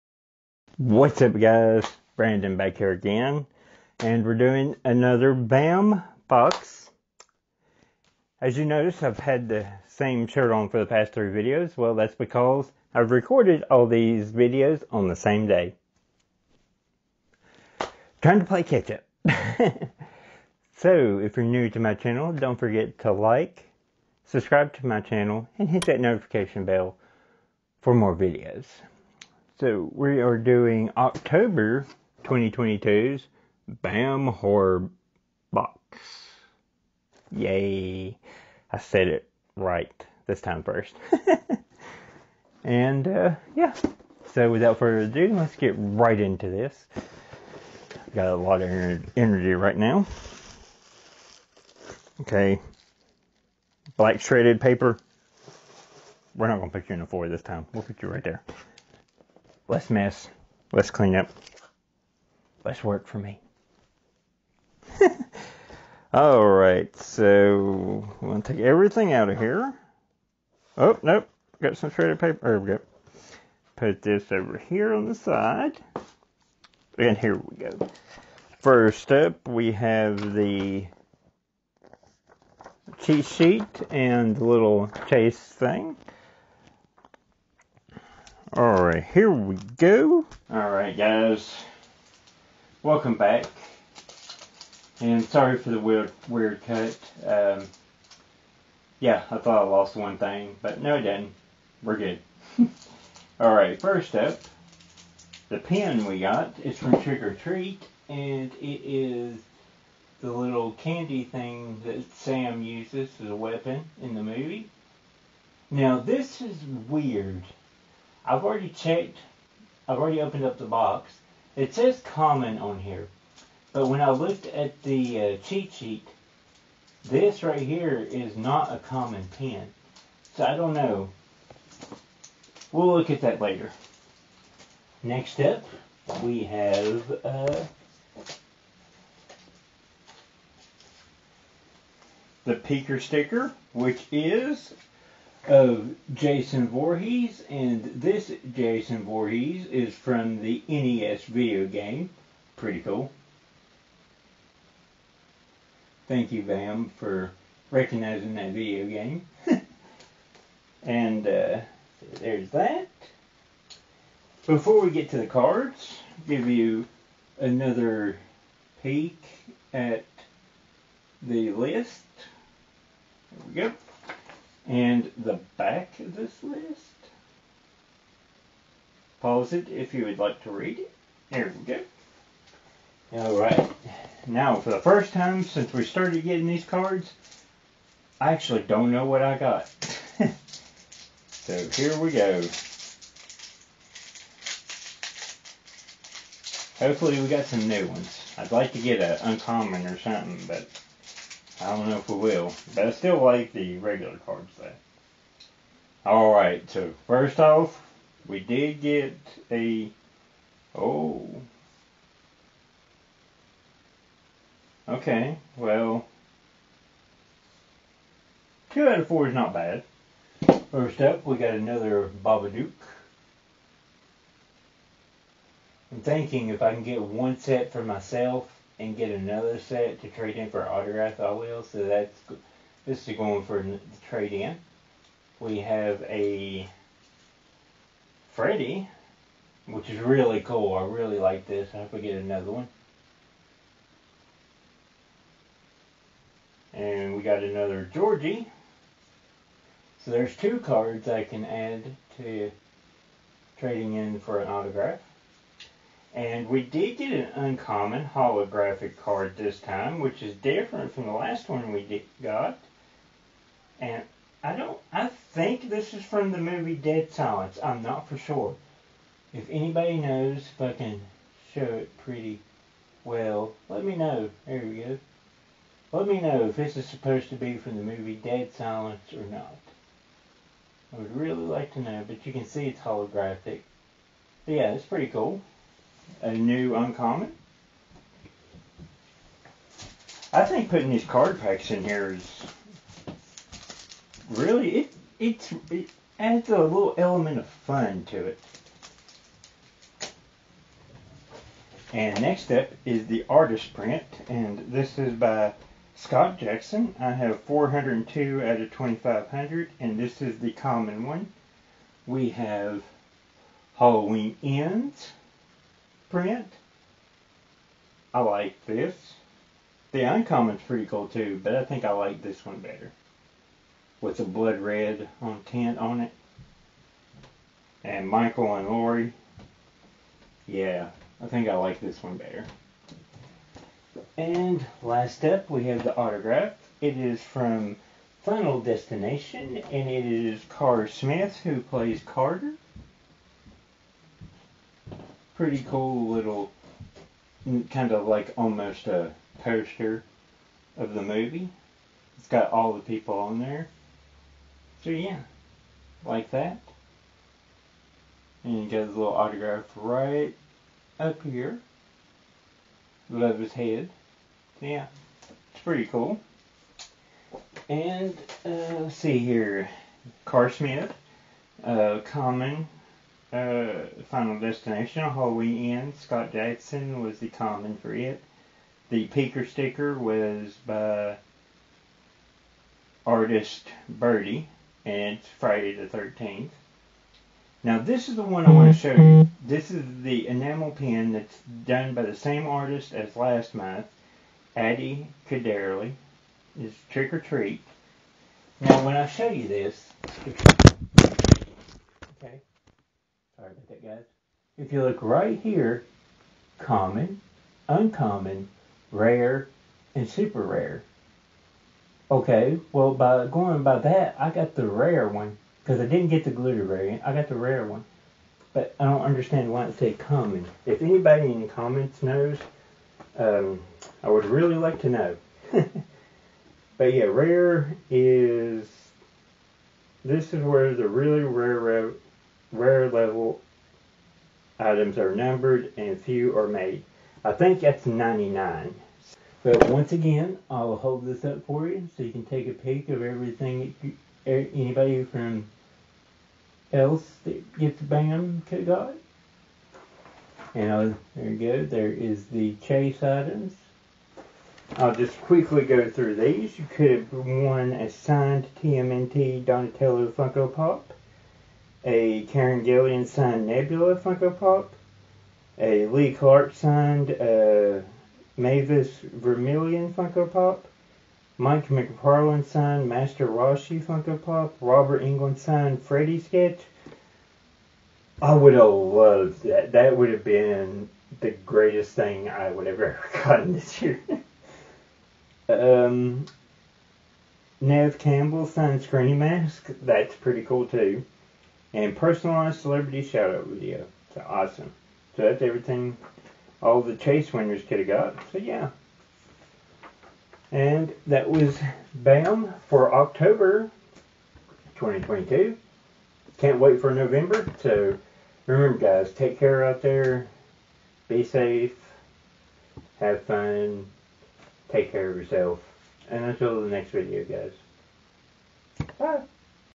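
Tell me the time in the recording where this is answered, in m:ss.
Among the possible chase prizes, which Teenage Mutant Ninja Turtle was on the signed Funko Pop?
7:39.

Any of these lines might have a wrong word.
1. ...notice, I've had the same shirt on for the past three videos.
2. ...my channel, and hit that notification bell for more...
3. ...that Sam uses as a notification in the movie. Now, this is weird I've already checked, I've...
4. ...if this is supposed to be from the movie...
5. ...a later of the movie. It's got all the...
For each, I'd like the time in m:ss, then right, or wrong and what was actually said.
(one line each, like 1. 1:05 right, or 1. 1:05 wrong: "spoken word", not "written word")
1. 0:08 right
2. 0:24 right
3. 1:51 wrong: "weapon", not "notification"
4. 4:36 right
5. 5:48 wrong: "poster", not "later".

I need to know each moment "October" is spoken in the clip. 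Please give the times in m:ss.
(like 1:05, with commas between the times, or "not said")
0:30, 8:22.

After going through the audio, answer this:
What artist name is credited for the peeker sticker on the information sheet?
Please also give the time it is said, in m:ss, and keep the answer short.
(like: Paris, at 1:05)
Birdie, at 6:23.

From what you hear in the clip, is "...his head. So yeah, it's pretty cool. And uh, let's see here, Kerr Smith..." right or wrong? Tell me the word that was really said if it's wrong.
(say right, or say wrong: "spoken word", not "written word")
right.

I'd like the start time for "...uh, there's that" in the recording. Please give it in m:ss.
2:41.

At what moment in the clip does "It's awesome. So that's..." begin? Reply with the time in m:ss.
8:14.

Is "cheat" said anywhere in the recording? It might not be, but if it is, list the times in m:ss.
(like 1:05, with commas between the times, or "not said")
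1:23, 2:05.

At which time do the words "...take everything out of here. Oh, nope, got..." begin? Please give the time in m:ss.
1:08.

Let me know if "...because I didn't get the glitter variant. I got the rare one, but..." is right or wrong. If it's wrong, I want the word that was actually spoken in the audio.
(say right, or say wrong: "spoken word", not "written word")
right.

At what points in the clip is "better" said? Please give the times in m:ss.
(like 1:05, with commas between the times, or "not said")
5:22, 5:32.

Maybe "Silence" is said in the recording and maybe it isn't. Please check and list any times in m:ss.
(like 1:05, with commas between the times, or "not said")
4:27, 4:38.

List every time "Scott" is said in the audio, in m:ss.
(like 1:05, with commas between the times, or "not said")
5:05, 6:16.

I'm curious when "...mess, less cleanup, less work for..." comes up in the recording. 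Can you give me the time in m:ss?
0:59.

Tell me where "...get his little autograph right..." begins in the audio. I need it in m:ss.
5:58.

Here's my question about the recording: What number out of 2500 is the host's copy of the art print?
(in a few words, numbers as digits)
402.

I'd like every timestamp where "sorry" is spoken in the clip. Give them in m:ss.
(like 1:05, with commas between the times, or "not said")
1:35, 6:43.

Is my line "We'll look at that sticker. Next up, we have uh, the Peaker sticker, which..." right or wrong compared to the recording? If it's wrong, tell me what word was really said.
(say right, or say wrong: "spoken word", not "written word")
wrong: "later", not "sticker".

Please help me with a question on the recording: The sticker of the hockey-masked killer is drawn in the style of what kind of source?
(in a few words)
NES video game.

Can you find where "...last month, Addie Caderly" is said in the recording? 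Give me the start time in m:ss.
6:33.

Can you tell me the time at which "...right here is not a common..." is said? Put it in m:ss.
2:07.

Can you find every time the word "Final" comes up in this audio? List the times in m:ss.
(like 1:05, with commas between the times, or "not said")
5:38, 6:14.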